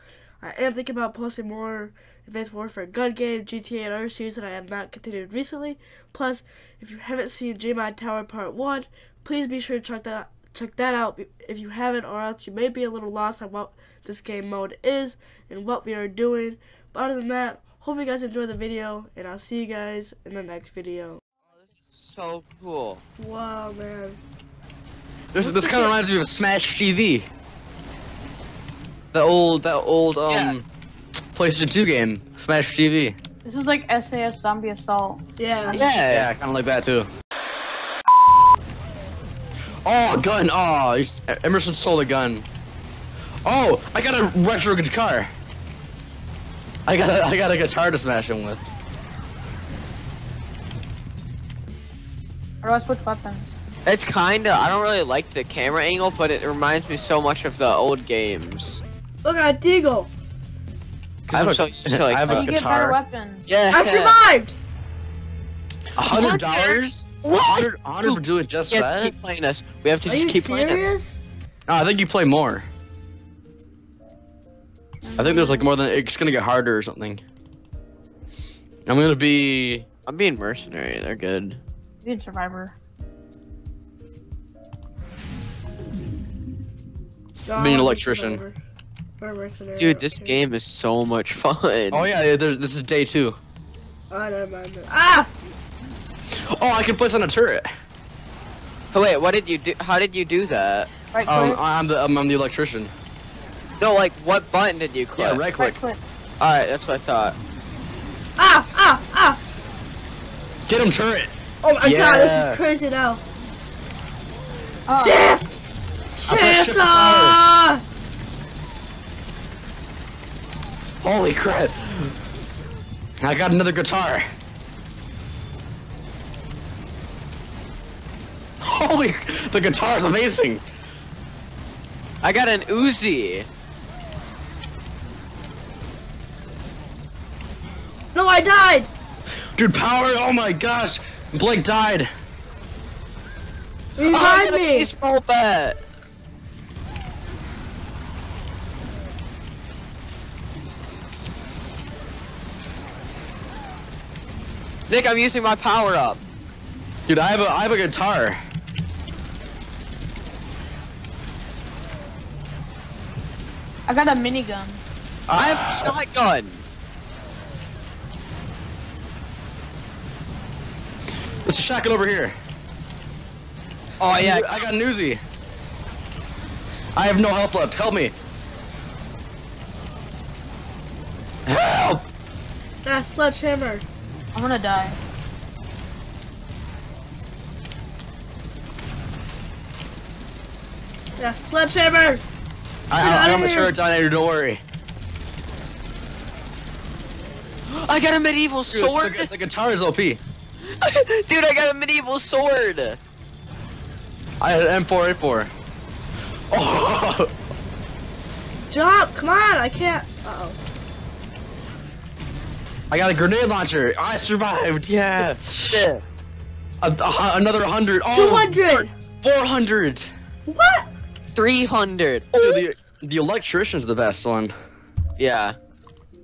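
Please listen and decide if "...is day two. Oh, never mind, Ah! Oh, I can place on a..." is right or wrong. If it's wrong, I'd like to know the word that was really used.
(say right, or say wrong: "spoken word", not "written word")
right.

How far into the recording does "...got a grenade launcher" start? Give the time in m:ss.
3:32.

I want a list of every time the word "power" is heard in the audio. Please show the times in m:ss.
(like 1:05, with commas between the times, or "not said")
2:19, 2:35.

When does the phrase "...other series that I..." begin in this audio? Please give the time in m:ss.
0:03.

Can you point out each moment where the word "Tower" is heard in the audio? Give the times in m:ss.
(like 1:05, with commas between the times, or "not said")
0:07.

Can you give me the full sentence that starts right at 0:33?
This is like SAS Zombie Assault.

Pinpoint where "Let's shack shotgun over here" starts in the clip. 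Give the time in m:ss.
2:51.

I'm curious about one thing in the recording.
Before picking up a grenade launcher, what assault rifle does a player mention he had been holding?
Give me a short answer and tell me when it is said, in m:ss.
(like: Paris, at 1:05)
M4A4, at 3:24.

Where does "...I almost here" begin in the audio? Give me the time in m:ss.
3:13.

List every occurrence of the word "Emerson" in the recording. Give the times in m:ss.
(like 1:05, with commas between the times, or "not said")
0:41.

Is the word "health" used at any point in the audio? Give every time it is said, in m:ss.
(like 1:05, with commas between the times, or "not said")
2:57.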